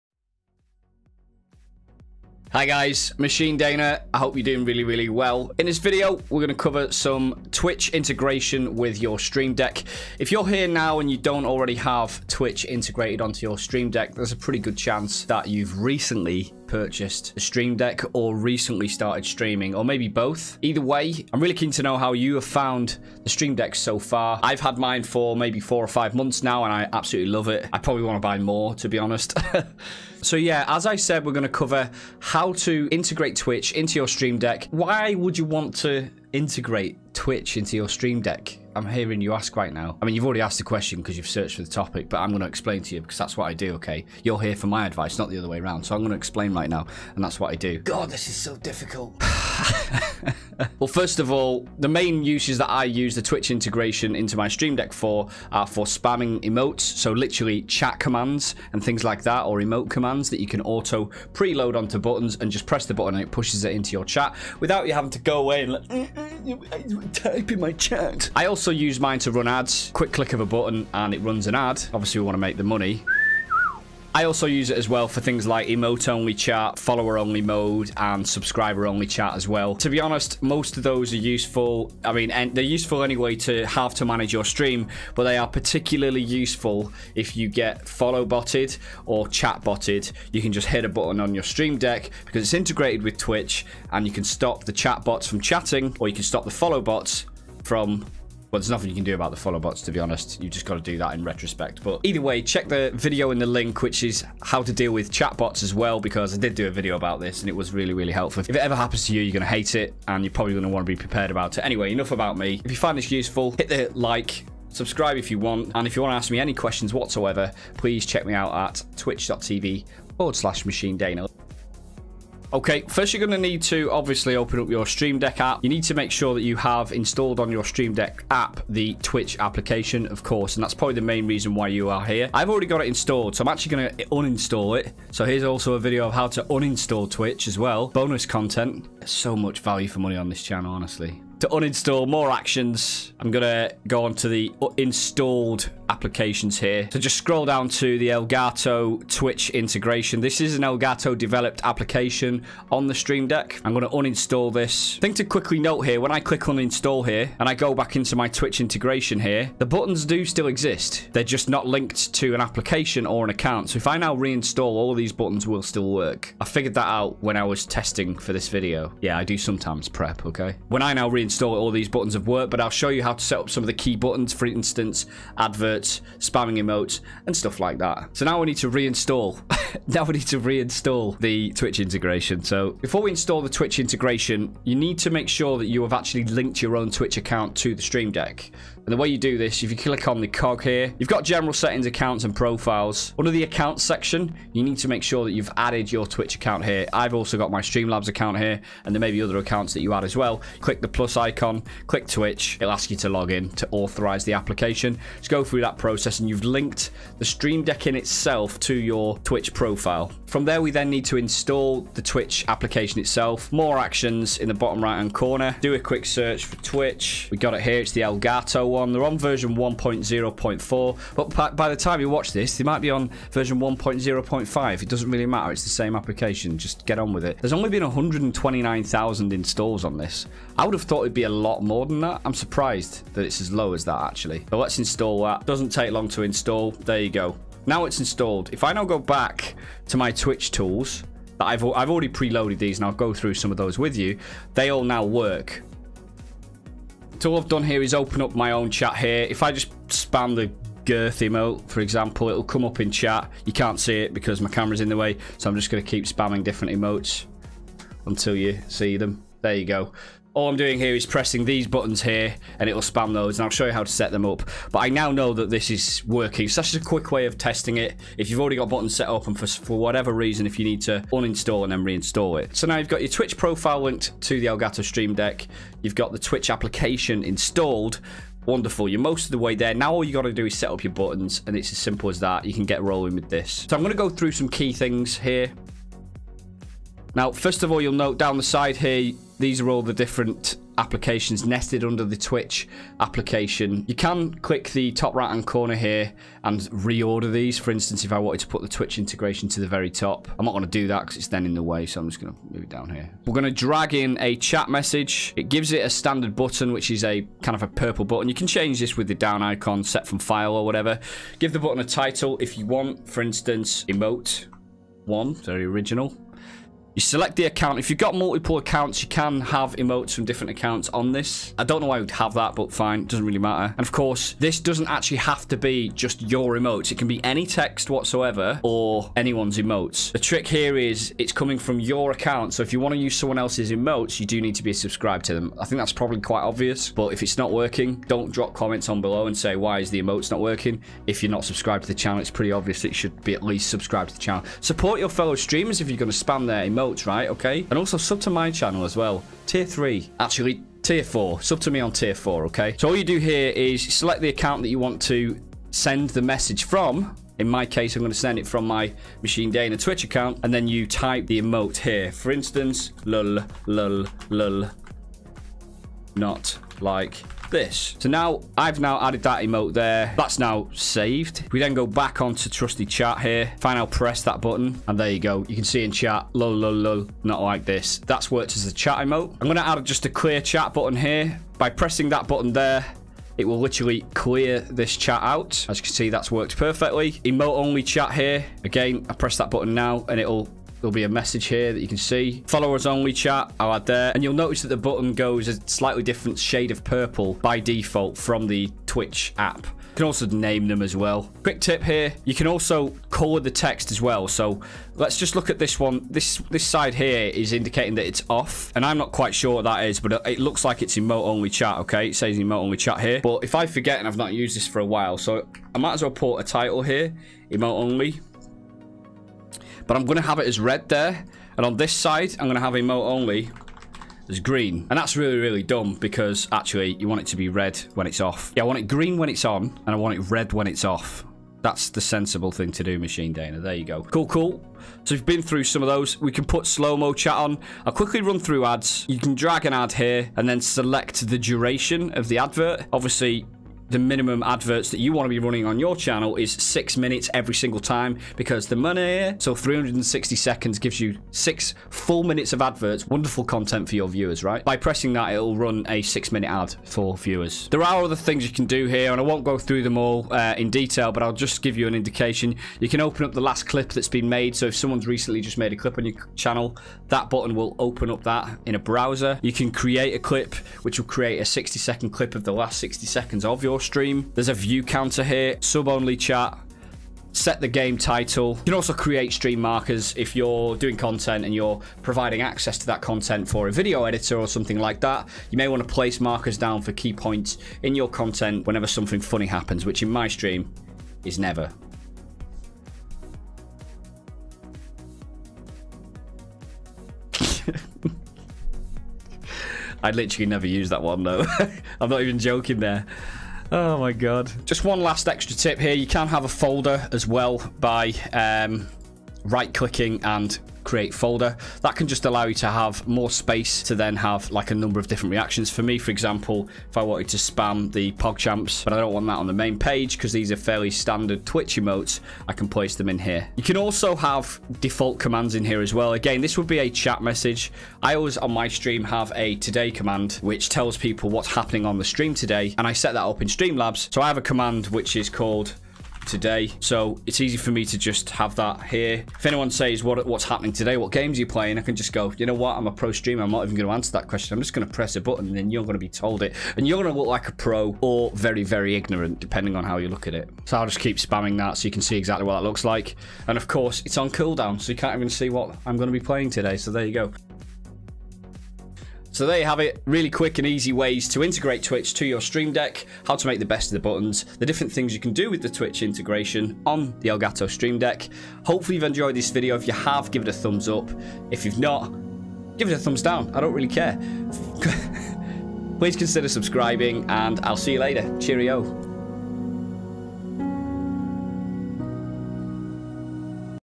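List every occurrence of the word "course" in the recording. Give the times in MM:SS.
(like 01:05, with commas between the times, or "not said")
02:10, 05:23, 09:13.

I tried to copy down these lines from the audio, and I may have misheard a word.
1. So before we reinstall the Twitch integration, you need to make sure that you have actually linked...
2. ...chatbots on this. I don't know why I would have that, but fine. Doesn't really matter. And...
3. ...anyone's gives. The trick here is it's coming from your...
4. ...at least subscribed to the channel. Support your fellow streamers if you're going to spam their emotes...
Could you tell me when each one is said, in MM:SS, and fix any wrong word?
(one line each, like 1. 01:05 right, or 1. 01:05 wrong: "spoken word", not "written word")
1. 03:02 wrong: "install", not "reinstall"
2. 05:20 wrong: "accounts", not "chatbots"
3. 05:29 wrong: "emotes", not "gives"
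4. 05:43 right.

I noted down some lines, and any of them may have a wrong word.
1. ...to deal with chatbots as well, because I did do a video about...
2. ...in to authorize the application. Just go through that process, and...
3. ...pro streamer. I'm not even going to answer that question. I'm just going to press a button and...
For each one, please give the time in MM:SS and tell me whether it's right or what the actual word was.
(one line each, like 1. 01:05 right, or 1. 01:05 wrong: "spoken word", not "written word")
1. 01:44 right
2. 03:23 right
3. 09:02 right.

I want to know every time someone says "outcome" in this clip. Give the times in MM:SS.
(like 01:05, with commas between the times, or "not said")
not said.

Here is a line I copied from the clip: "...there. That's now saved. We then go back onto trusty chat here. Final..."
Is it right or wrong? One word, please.
right.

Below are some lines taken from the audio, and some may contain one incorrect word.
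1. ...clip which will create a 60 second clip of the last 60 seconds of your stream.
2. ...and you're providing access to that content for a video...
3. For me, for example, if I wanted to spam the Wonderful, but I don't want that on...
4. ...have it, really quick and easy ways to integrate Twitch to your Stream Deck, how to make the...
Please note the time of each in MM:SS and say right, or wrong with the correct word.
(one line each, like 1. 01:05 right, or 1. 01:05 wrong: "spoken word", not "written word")
1. 07:50 right
2. 08:01 right
3. 08:35 wrong: "PogChamps", not "Wonderful"
4. 09:19 right.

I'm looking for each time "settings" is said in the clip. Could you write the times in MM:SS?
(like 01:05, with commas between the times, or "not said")
03:11.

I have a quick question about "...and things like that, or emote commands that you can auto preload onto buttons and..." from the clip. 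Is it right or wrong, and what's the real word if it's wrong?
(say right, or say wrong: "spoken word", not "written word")
right.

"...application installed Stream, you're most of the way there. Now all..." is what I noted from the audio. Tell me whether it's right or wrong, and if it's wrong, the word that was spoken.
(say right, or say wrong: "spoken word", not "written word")
wrong: "Wonderful", not "Stream".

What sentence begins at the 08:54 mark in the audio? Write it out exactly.
So I have a command which is called today.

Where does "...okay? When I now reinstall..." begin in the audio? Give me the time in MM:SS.
02:50.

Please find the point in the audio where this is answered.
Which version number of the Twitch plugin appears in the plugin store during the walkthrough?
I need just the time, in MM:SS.
03:39.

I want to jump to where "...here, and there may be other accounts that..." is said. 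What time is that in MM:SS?
03:18.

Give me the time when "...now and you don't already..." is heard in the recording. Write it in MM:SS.
00:10.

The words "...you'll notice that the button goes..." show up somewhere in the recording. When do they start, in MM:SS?
06:34.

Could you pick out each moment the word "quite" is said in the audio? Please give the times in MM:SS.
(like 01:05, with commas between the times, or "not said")
05:36, 06:49.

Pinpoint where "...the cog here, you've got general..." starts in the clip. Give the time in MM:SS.
03:10.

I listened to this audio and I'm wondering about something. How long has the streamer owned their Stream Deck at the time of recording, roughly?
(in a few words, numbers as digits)
4 or 5 months.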